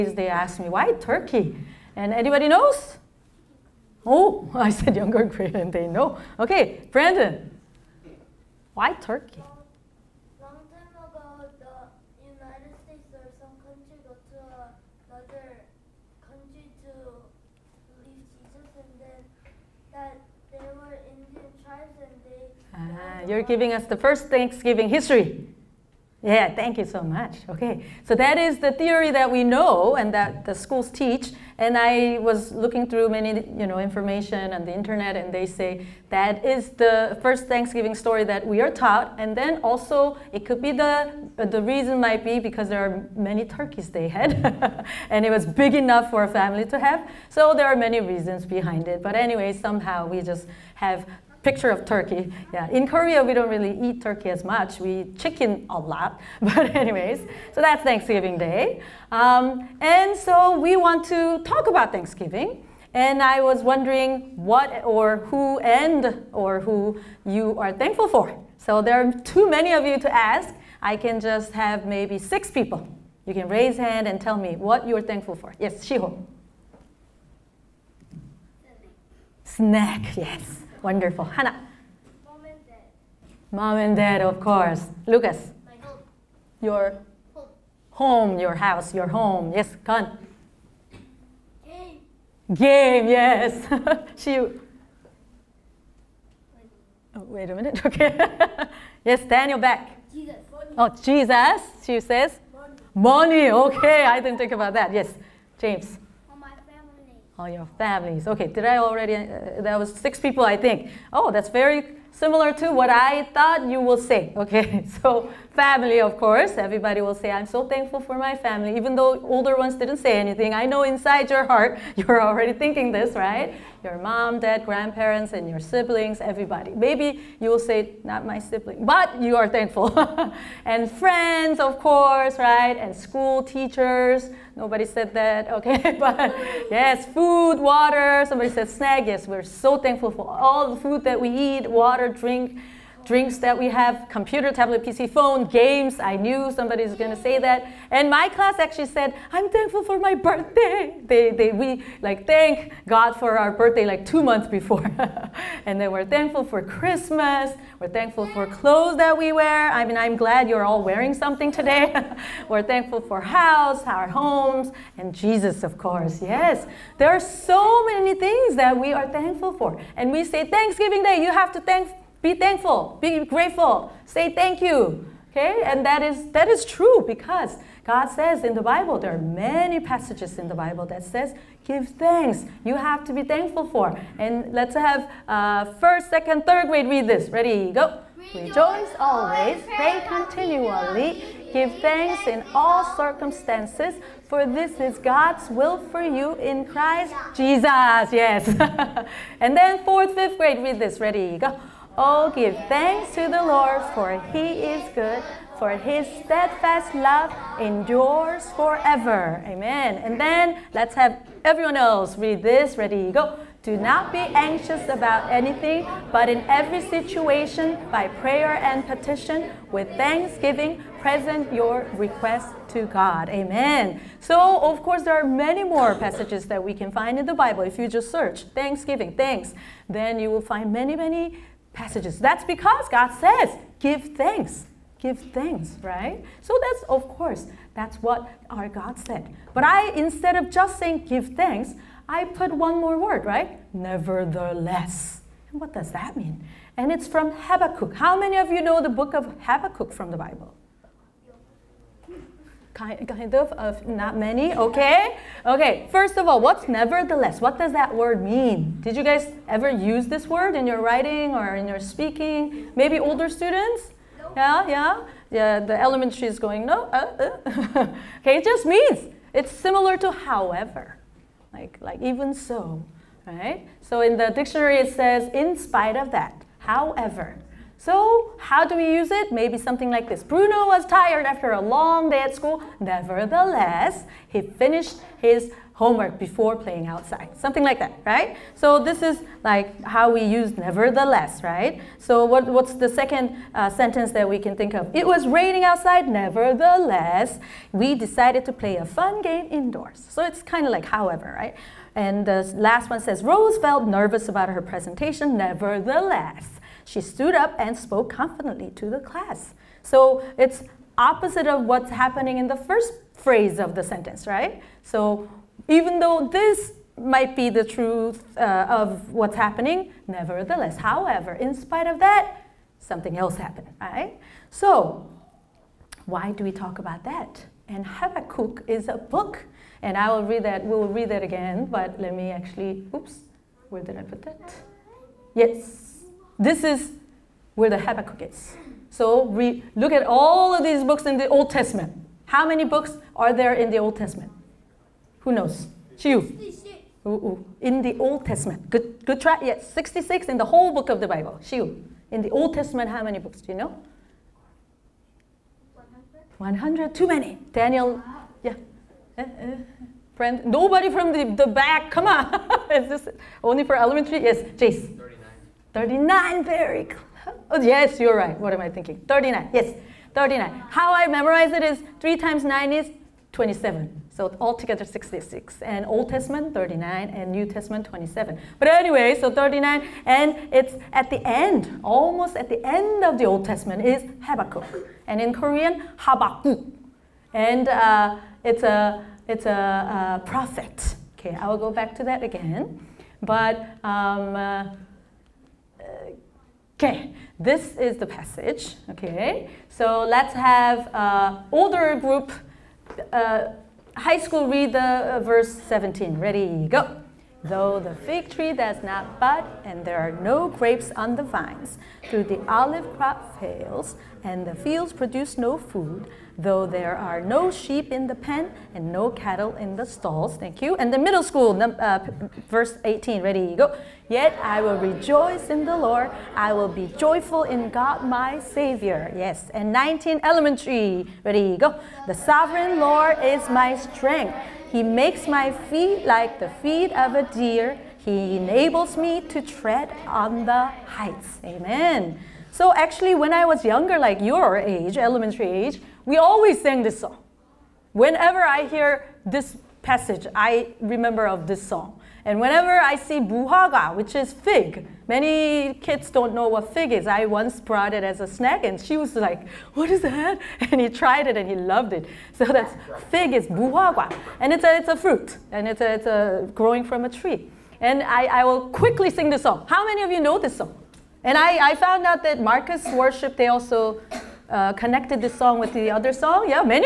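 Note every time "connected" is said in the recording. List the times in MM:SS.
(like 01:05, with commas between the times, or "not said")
07:54.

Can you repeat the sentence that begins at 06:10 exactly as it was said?
How I memorize it is 3 times 9 is 27.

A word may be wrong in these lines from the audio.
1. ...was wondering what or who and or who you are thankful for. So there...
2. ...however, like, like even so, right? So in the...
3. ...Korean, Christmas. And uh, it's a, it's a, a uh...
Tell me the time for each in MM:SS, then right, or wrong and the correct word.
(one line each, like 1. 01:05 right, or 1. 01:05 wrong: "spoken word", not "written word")
1. 01:03 right
2. 04:30 right
3. 06:25 wrong: "Habakkuk", not "Christmas".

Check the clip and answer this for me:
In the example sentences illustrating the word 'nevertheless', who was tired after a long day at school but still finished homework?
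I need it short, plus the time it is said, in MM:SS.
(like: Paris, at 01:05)
Bruno, at 04:40.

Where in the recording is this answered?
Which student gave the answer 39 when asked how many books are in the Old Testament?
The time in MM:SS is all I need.
06:04.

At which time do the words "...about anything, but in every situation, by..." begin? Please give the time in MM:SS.
03:34.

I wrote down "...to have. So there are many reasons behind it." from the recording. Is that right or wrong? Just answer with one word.
right.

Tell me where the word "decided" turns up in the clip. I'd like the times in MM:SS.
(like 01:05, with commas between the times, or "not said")
04:57.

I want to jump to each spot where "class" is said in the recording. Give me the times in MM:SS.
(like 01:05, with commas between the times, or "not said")
02:28, 05:08.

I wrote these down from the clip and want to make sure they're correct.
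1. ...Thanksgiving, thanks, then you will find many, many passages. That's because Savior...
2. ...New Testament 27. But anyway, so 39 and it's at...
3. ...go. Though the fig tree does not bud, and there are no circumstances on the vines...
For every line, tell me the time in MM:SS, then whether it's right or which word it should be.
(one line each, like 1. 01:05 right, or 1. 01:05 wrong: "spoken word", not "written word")
1. 03:48 wrong: "God", not "Savior"
2. 06:17 right
3. 06:46 wrong: "grapes", not "circumstances".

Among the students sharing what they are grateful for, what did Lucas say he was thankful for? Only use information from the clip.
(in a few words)
My home.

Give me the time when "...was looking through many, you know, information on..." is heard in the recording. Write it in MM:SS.
00:32.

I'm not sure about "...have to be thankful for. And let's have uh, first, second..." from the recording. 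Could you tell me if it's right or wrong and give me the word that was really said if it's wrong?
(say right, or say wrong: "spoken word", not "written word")
right.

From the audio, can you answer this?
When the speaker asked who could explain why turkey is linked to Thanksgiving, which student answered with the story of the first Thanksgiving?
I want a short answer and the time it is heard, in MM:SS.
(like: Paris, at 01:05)
Brandon, at 00:06.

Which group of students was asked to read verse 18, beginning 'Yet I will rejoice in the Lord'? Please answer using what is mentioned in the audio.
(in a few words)
Middle school.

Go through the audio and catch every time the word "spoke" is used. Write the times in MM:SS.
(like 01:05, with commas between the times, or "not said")
05:07.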